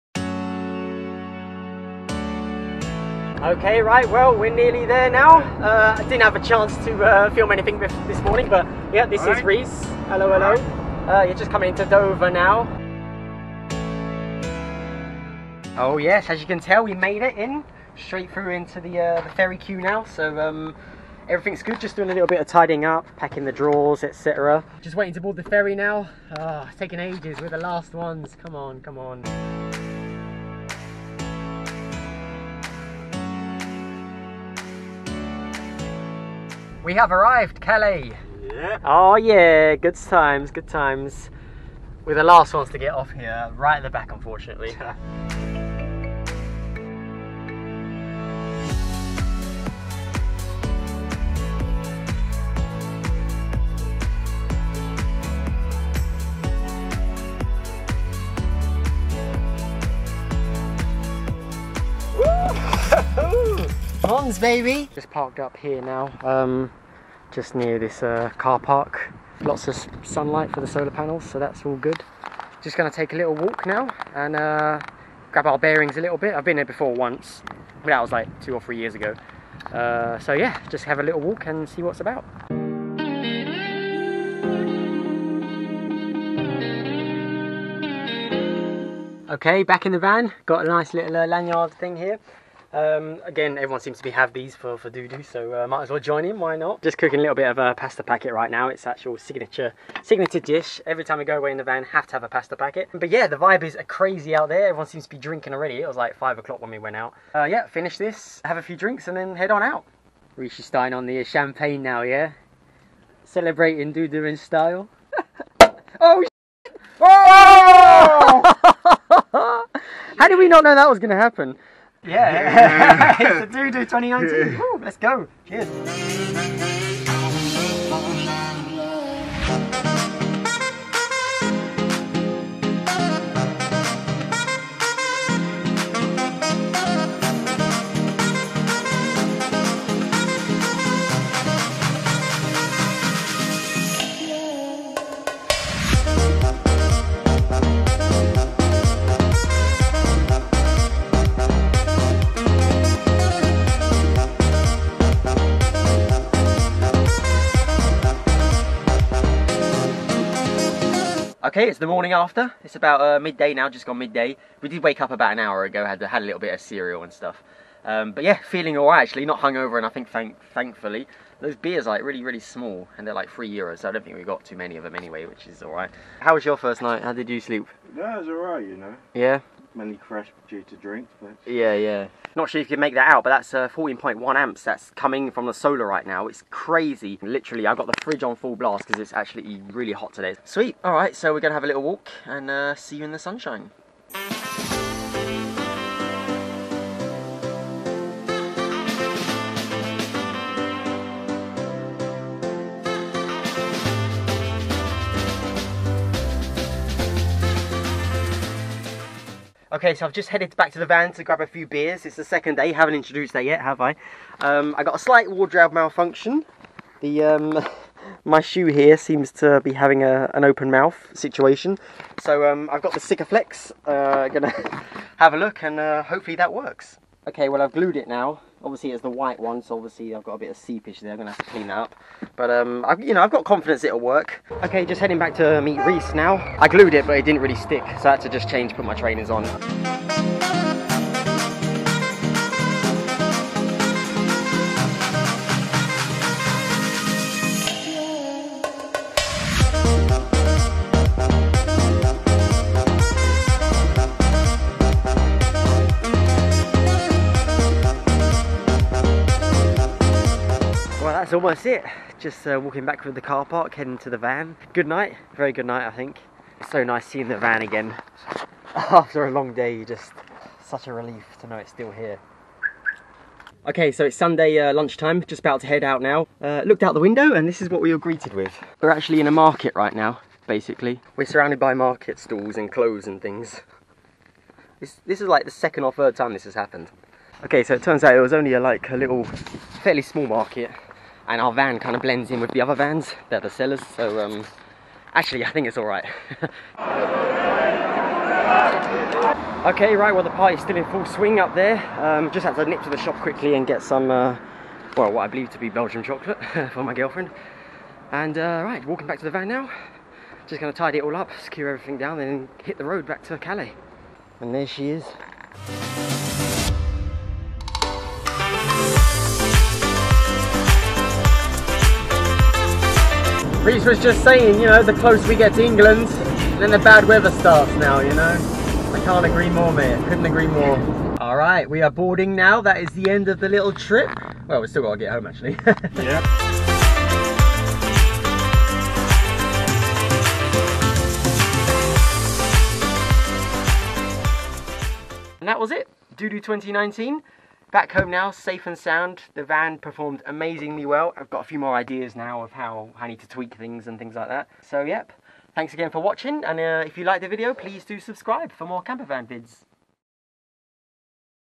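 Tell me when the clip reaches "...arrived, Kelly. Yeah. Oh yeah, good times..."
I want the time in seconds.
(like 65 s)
37 s.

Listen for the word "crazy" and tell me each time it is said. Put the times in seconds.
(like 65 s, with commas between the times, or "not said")
103 s, 186 s.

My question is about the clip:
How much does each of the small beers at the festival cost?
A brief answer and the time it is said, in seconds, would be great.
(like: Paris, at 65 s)
3 euros, at 173 s.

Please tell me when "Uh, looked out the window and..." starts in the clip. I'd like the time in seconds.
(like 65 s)
276 s.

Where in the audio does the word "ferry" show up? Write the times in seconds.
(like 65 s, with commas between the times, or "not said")
19 s, 25 s.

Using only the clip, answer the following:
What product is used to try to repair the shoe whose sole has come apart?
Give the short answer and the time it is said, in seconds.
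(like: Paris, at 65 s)
Sikaflex, at 222 s.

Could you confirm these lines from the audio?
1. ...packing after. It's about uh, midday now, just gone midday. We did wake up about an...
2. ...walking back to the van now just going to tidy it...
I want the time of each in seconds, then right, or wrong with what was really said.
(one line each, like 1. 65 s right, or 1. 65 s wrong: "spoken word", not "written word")
1. 161 s wrong: "morning", not "packing"
2. 308 s right.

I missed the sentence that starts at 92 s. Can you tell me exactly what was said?
Um, again, everyone seems to be have these for, for Doudou, so uh, might as well join in, why not?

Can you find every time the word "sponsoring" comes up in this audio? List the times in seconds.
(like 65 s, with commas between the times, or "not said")
not said.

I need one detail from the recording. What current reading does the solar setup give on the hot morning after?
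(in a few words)
14.1 amps.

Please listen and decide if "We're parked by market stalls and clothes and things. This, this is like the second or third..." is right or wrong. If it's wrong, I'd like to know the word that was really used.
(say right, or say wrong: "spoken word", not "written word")
wrong: "surrounded", not "parked".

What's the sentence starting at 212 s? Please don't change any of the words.
It's the second day, haven't introduced that yet, have I?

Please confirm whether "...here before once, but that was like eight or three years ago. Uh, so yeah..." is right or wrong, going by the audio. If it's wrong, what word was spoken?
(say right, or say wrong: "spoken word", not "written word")
wrong: "two", not "eight".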